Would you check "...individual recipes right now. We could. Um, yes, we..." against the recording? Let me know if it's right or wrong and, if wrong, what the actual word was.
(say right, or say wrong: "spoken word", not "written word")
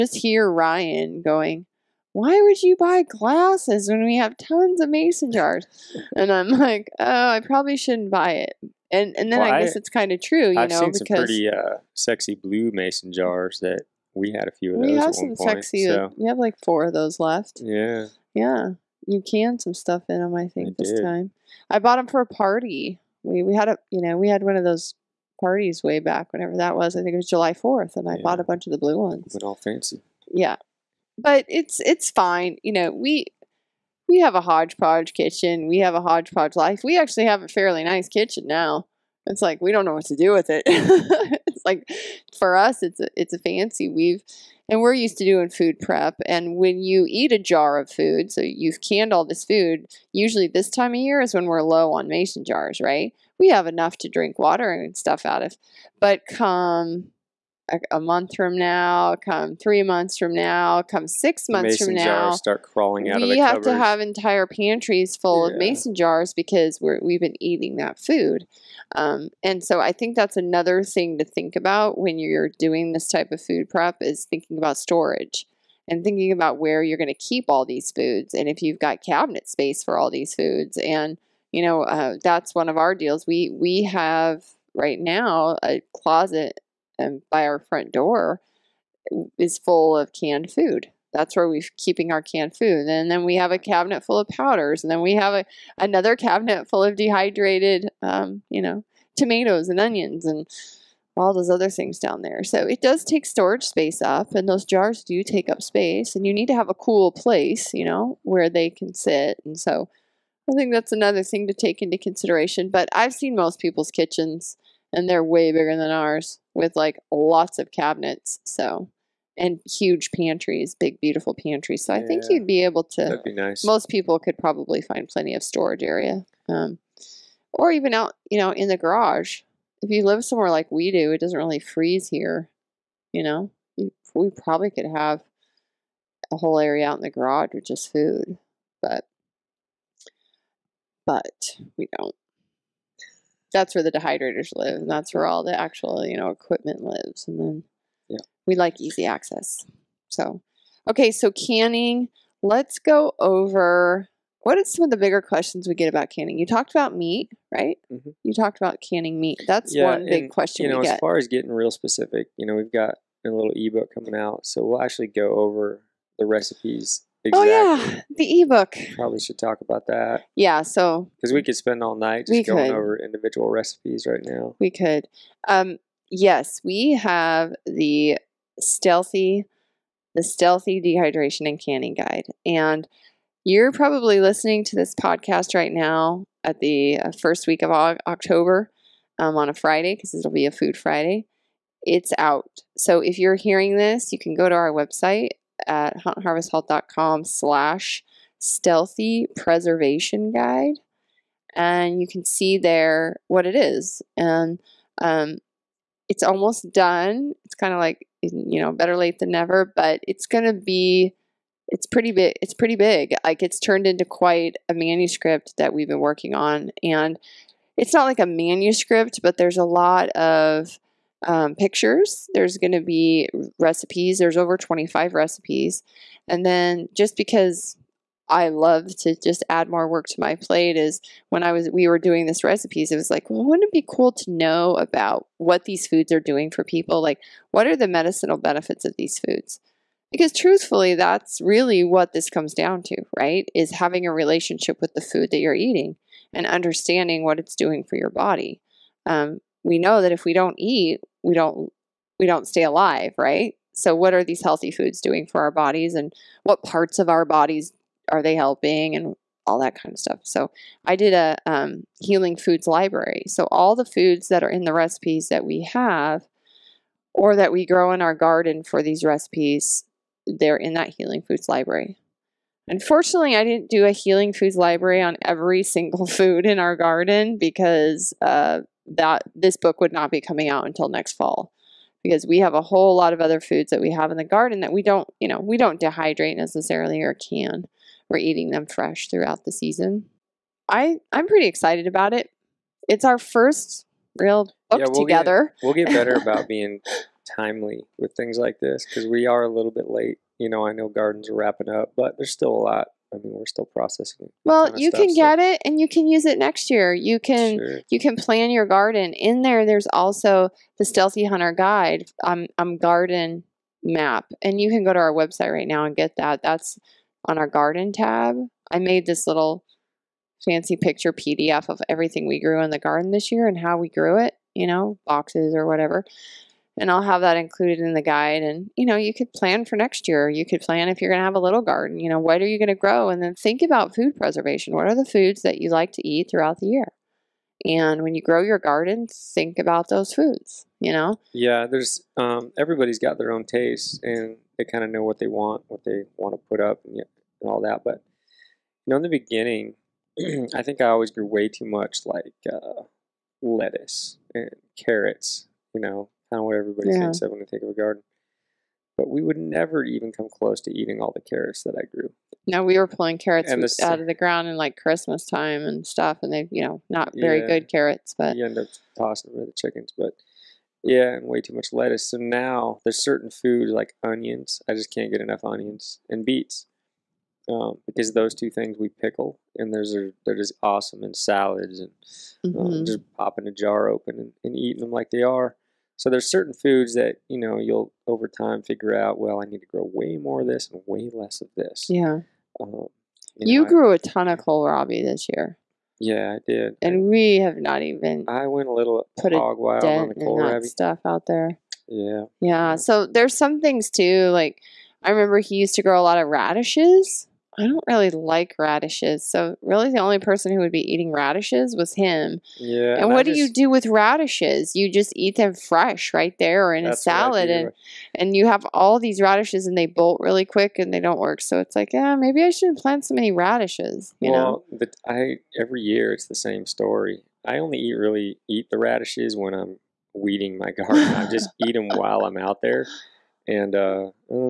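right.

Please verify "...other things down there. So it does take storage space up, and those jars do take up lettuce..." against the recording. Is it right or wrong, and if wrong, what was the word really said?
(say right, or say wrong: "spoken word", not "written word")
wrong: "space", not "lettuce".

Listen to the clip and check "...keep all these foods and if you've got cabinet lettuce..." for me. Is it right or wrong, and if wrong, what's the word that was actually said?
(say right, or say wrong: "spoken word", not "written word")
wrong: "space", not "lettuce".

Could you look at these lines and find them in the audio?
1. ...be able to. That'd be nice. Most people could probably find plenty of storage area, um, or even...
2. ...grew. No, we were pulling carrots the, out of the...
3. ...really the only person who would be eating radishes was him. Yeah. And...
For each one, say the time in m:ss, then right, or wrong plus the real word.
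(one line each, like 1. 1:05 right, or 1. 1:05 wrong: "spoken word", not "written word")
1. 2:02 right
2. 6:01 right
3. 6:49 right.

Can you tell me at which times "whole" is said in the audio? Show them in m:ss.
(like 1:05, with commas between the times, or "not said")
2:16, 4:42.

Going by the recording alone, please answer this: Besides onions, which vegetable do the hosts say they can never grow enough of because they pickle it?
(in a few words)
beets.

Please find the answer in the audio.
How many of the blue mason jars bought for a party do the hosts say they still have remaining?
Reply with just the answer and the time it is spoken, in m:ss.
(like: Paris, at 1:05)
4, at 0:16.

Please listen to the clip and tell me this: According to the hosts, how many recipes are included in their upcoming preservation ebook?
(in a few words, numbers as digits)
over 25.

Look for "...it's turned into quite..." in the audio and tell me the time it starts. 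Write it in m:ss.
3:33.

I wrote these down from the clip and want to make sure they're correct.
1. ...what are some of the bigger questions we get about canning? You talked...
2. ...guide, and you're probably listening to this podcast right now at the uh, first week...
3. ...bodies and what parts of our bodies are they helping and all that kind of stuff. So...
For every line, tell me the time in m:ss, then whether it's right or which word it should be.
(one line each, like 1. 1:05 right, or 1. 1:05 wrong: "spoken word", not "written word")
1. 2:34 right
2. 3:01 right
3. 4:15 right.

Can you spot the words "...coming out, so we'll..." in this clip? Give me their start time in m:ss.
2:43.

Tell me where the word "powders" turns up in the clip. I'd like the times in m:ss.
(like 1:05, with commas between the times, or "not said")
1:34.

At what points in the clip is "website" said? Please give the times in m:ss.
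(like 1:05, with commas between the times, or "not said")
3:14, 5:15.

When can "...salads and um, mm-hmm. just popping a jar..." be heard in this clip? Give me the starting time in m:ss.
6:21.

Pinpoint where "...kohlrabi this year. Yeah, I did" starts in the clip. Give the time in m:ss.
6:34.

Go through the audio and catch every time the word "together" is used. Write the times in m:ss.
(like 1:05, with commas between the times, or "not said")
4:55.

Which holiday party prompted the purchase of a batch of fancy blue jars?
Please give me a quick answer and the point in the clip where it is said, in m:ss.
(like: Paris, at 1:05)
July 4th, at 0:27.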